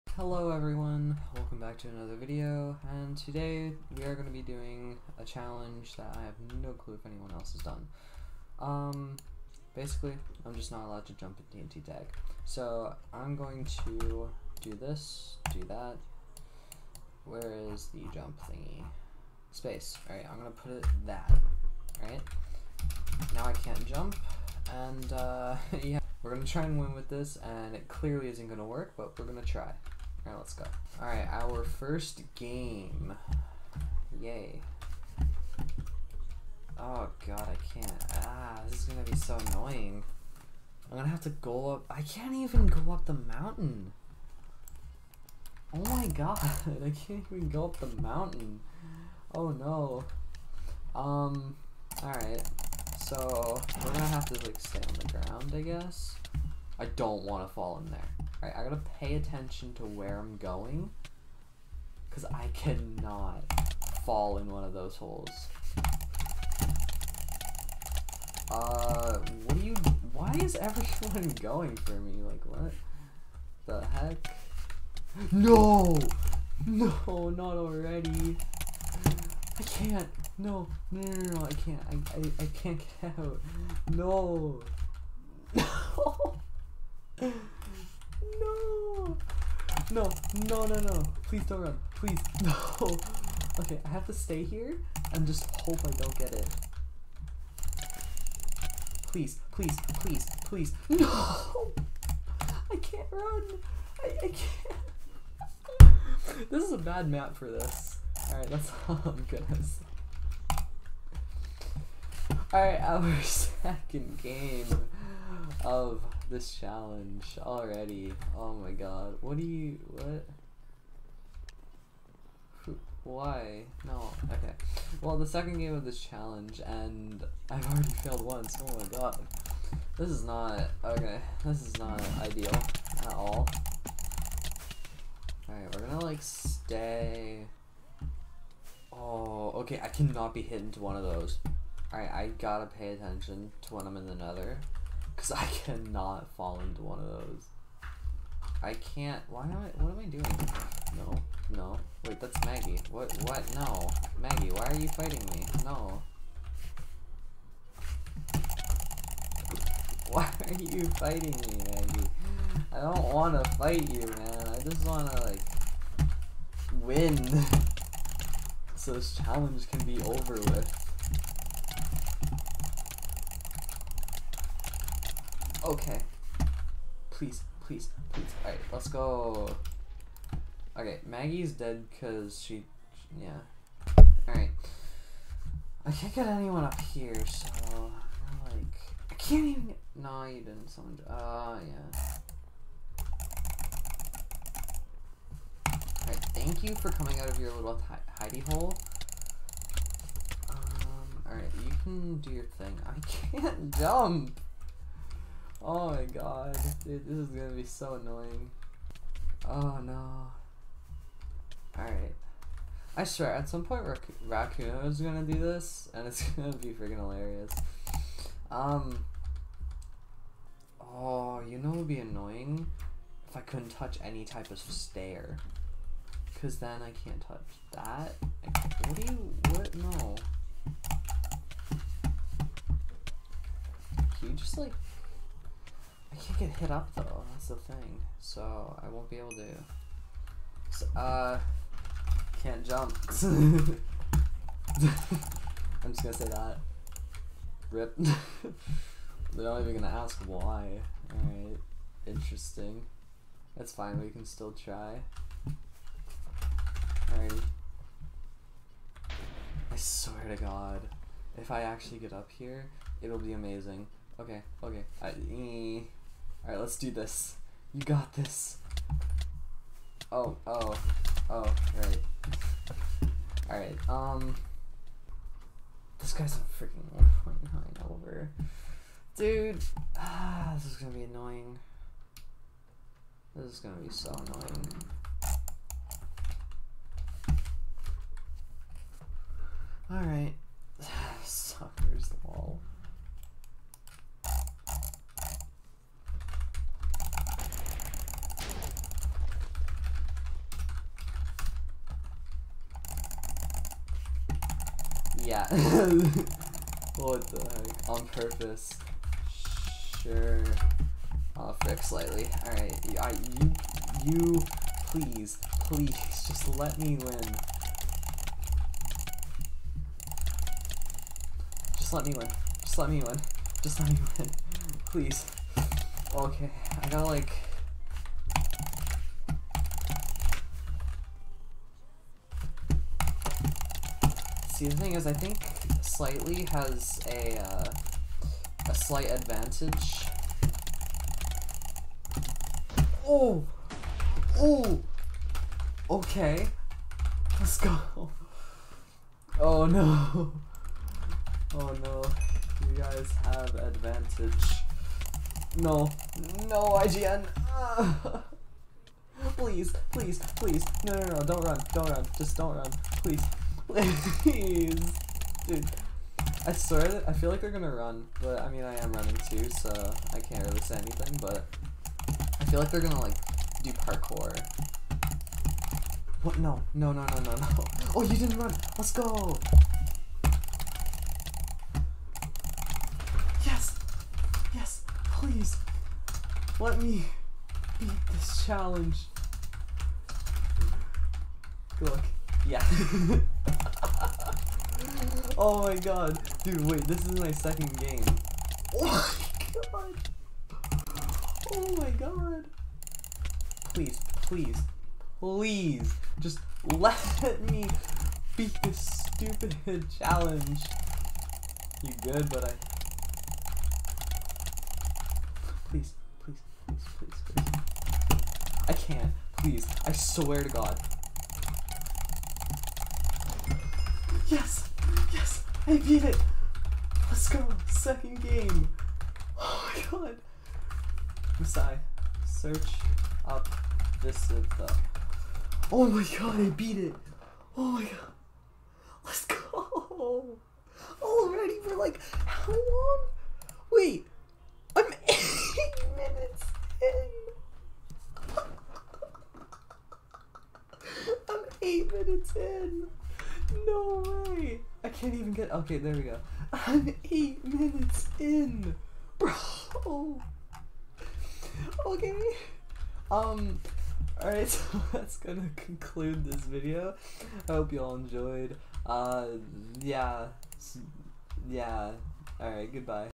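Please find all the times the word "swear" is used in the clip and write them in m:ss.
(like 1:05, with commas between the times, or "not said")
3:33, 4:19, 6:06, 6:59.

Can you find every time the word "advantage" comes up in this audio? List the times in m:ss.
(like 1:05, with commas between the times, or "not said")
5:39, 5:53.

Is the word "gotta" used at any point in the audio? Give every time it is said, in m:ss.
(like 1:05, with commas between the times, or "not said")
0:58, 2:22, 5:26.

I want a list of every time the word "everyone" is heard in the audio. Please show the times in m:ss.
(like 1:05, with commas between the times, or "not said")
0:00, 1:10.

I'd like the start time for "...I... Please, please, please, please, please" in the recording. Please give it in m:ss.
6:52.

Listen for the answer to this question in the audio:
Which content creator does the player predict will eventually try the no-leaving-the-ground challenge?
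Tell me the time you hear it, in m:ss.
3:34.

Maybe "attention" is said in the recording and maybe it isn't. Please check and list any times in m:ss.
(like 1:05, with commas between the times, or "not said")
0:59, 2:22.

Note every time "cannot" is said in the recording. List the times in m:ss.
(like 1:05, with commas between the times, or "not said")
1:02, 2:19, 2:25.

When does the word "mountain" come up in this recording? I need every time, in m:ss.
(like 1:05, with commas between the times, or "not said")
0:43, 0:48.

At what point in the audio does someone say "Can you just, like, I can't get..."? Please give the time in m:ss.
3:54.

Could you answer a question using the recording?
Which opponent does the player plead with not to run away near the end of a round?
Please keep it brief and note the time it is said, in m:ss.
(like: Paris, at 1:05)
IGN, at 5:56.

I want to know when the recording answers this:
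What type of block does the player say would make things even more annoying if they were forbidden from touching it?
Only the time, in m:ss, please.
3:44.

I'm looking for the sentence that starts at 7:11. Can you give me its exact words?
Masai, search up this is the.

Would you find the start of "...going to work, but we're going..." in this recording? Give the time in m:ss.
0:28.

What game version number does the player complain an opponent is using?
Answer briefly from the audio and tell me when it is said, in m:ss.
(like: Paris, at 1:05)
1.9, at 4:37.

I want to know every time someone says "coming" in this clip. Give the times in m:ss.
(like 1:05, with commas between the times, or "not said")
3:16.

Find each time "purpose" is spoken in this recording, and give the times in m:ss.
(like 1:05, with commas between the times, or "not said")
5:08.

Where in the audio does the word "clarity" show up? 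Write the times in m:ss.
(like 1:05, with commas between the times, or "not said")
not said.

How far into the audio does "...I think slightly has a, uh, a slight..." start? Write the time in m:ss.
5:35.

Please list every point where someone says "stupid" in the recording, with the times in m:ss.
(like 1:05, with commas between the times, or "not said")
6:49.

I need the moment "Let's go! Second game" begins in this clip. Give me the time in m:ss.
7:07.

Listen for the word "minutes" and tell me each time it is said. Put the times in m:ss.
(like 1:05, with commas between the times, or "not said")
7:25, 7:31, 7:37.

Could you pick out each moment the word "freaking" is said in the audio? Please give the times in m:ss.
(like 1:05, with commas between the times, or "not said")
3:36, 4:36.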